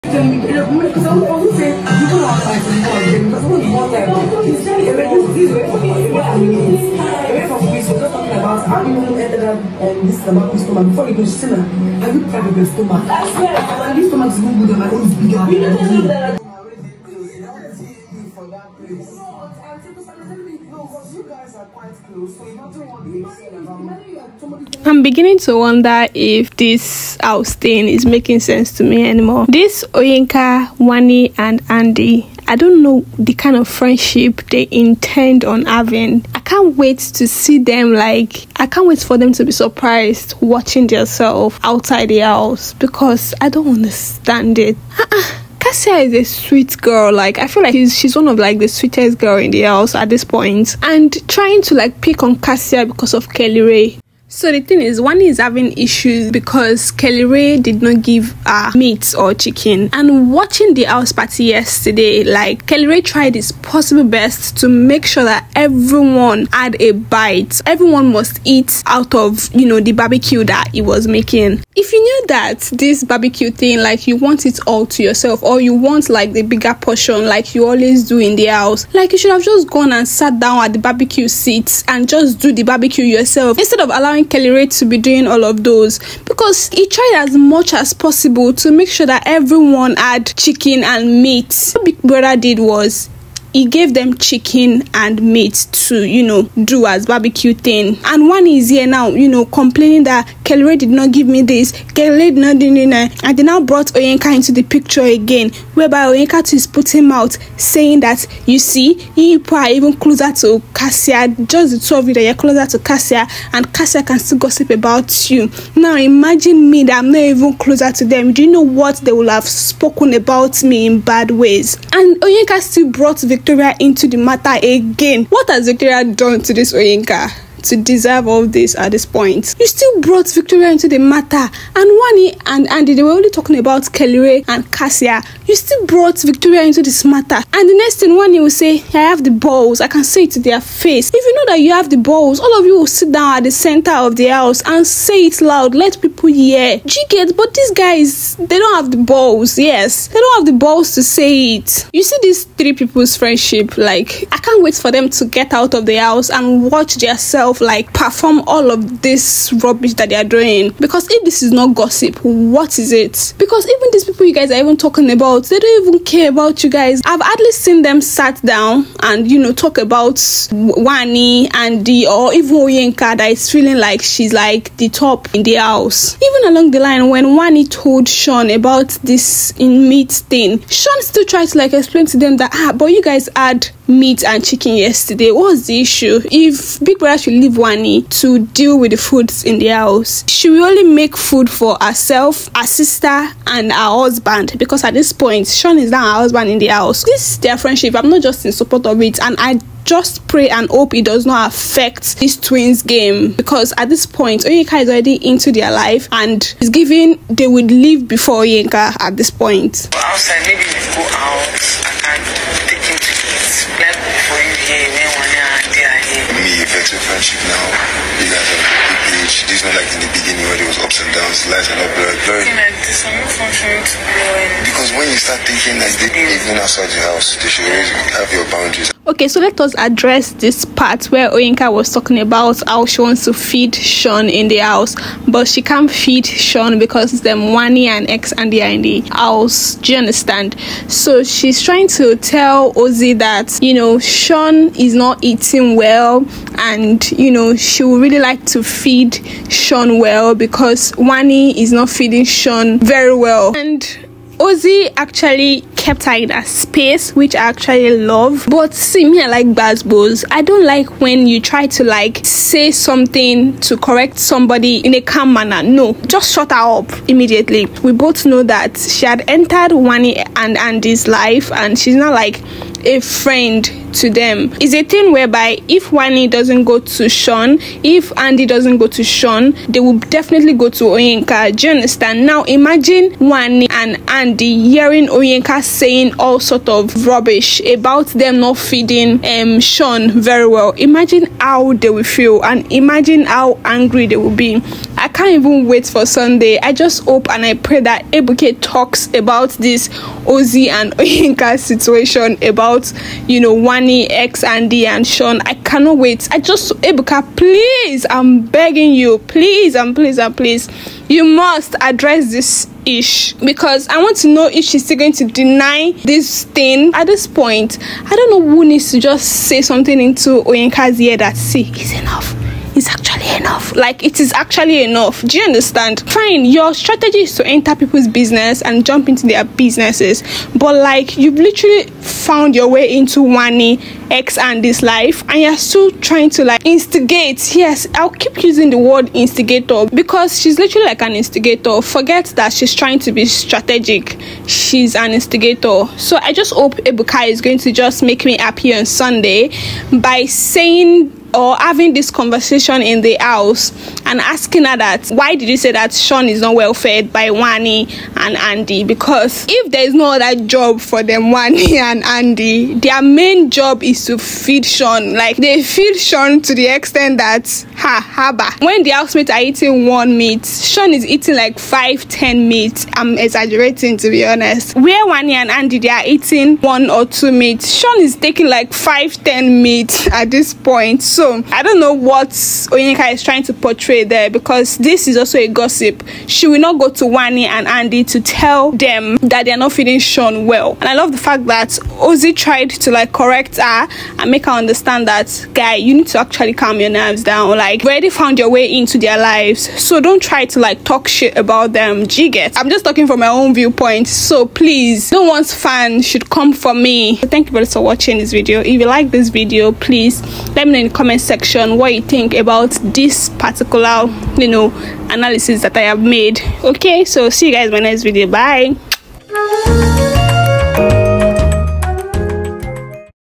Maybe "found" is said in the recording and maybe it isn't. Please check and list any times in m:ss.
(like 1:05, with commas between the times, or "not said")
5:32, 6:38.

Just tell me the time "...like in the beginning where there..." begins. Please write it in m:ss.
3:39.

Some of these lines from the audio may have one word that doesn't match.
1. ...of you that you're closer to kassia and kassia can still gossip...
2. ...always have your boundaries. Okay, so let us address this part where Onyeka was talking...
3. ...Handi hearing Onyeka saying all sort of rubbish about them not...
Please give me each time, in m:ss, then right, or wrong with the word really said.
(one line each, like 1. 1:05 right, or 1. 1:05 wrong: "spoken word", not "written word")
1. 1:51 right
2. 3:47 right
3. 4:44 right.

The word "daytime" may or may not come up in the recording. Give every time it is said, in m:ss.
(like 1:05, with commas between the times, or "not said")
not said.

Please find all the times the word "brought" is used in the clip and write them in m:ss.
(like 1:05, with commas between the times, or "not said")
1:43, 2:02, 2:10, 2:15.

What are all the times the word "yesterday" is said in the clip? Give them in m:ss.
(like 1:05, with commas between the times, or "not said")
1:01, 3:04.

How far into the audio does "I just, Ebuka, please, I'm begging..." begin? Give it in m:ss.
5:06.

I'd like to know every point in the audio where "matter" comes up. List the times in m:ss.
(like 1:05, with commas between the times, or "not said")
2:04, 2:10, 2:17.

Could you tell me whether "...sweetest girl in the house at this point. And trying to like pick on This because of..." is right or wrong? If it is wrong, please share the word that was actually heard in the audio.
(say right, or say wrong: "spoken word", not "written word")
wrong: "Kassia", not "This".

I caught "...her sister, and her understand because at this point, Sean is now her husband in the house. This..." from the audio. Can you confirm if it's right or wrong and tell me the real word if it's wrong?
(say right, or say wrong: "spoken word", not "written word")
wrong: "husband", not "understand".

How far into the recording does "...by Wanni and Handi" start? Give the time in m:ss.
5:57.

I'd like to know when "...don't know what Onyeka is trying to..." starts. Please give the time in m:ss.
6:21.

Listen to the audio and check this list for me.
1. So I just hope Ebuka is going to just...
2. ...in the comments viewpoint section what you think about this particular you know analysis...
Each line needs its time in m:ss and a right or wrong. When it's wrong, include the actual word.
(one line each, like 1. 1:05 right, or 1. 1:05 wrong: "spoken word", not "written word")
1. 5:45 right
2. 6:50 wrong: "comment", not "viewpoint".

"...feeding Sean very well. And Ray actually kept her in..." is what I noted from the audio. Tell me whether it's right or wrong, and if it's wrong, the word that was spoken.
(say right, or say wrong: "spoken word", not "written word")
wrong: "Ozee", not "Ray".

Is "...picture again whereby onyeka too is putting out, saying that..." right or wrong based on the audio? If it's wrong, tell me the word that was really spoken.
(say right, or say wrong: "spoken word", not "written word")
right.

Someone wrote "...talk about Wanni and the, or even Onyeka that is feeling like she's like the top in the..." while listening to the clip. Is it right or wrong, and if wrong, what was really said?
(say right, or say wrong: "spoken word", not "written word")
right.